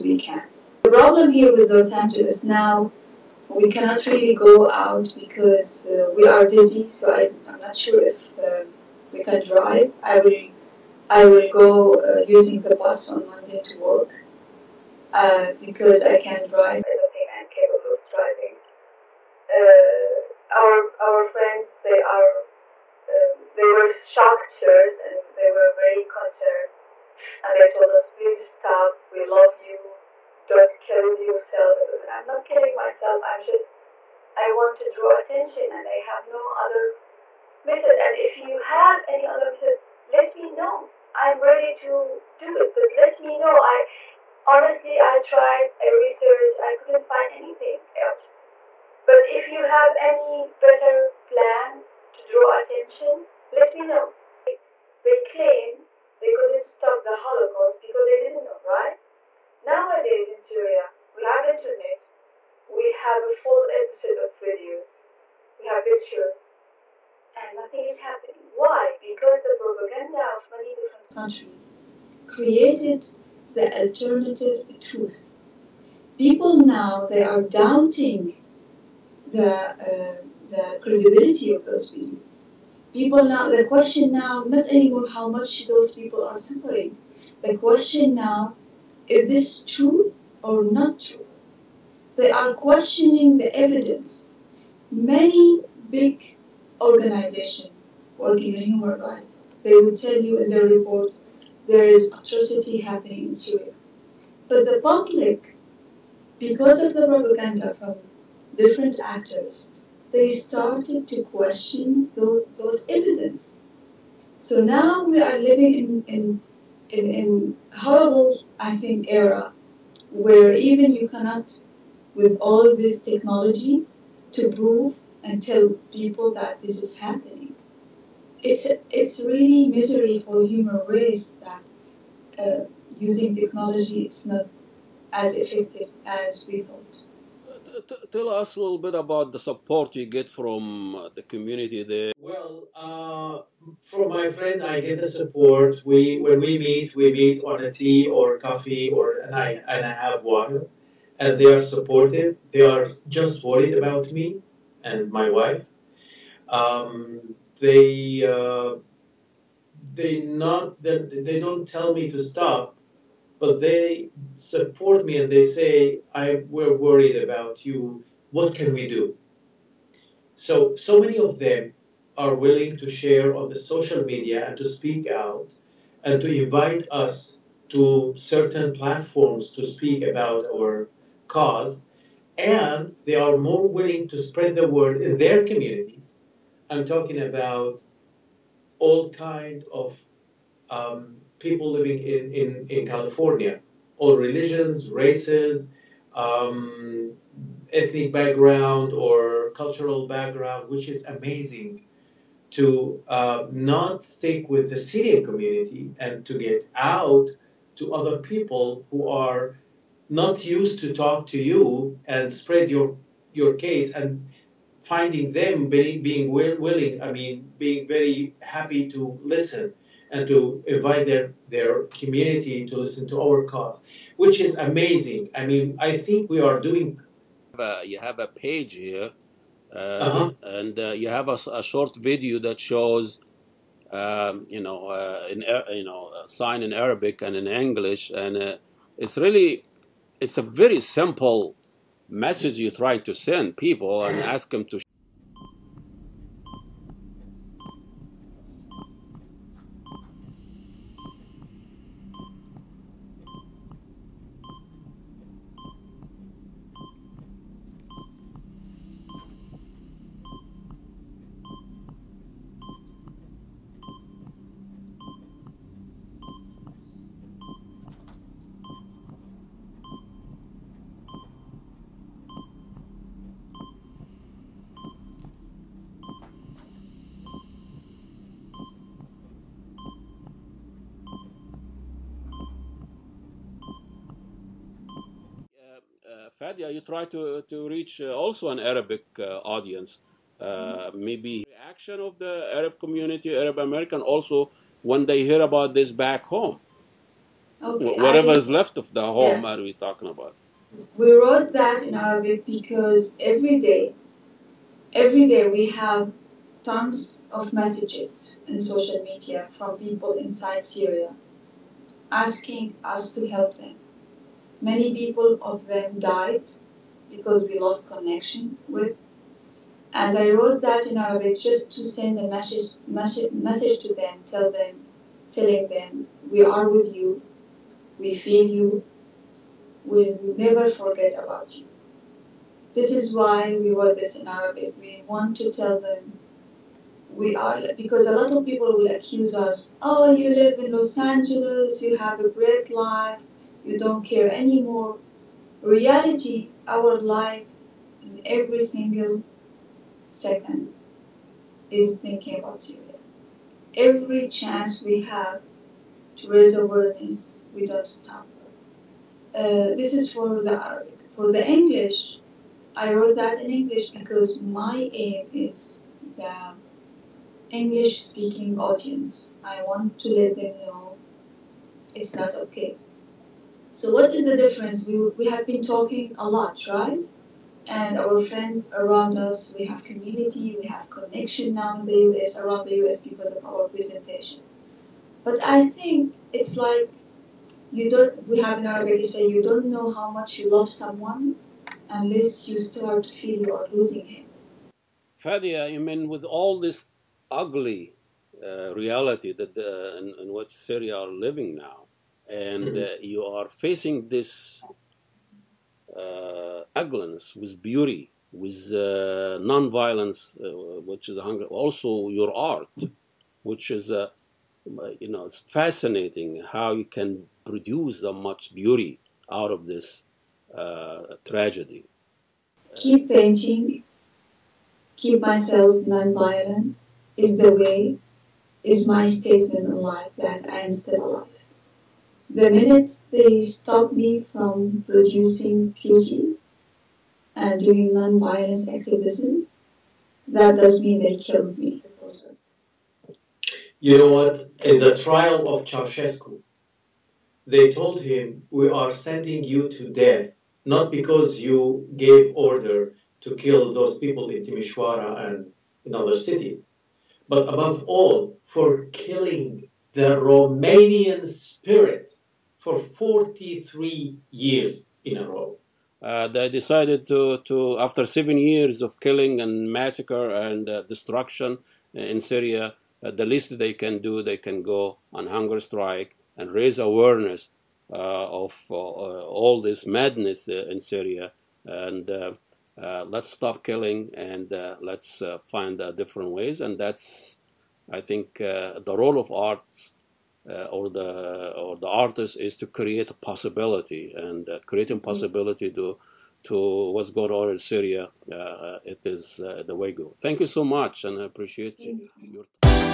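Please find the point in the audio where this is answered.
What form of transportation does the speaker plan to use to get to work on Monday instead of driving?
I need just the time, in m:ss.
0:12.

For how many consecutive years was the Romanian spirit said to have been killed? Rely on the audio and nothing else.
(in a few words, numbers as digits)
43.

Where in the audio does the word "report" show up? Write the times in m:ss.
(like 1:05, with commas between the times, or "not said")
1:40.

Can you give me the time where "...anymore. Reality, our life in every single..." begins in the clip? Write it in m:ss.
5:44.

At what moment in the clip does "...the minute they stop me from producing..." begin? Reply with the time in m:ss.
7:12.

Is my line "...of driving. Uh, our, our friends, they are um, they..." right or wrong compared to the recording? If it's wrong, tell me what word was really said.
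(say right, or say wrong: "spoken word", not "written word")
right.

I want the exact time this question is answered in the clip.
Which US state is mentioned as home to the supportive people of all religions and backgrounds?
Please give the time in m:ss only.
3:12.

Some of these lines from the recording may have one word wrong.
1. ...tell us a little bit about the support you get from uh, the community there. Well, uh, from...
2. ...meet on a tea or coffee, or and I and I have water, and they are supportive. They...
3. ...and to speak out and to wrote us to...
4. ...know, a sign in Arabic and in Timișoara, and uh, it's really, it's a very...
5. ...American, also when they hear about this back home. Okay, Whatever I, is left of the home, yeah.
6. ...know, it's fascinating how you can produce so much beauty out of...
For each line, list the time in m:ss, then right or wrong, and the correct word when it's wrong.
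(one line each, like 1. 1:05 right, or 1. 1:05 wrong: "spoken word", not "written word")
1. 2:18 right
2. 2:27 right
3. 2:54 wrong: "invite", not "wrote"
4. 3:55 wrong: "English", not "Timișoara"
5. 4:53 right
6. 6:55 right.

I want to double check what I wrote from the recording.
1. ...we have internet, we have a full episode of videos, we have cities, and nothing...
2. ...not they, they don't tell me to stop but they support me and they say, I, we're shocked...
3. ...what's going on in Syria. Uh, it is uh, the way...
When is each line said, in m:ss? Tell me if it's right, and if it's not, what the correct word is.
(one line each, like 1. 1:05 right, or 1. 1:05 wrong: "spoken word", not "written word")
1. 1:01 wrong: "pictures", not "cities"
2. 2:40 wrong: "worried", not "shocked"
3. 8:16 right.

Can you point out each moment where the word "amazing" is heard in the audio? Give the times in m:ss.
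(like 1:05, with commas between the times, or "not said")
3:21, 3:44.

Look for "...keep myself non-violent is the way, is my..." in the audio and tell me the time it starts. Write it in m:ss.
7:04.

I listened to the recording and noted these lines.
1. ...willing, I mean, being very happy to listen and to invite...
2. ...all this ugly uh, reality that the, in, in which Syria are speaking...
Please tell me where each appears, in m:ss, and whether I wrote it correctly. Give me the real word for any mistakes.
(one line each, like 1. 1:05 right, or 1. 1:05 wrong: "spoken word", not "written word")
1. 3:36 right
2. 6:36 wrong: "living", not "speaking".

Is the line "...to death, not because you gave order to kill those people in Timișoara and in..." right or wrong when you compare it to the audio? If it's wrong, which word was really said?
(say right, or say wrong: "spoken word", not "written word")
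right.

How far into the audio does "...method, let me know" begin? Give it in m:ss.
0:39.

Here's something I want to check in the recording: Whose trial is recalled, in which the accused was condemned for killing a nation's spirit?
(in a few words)
Ceausescu.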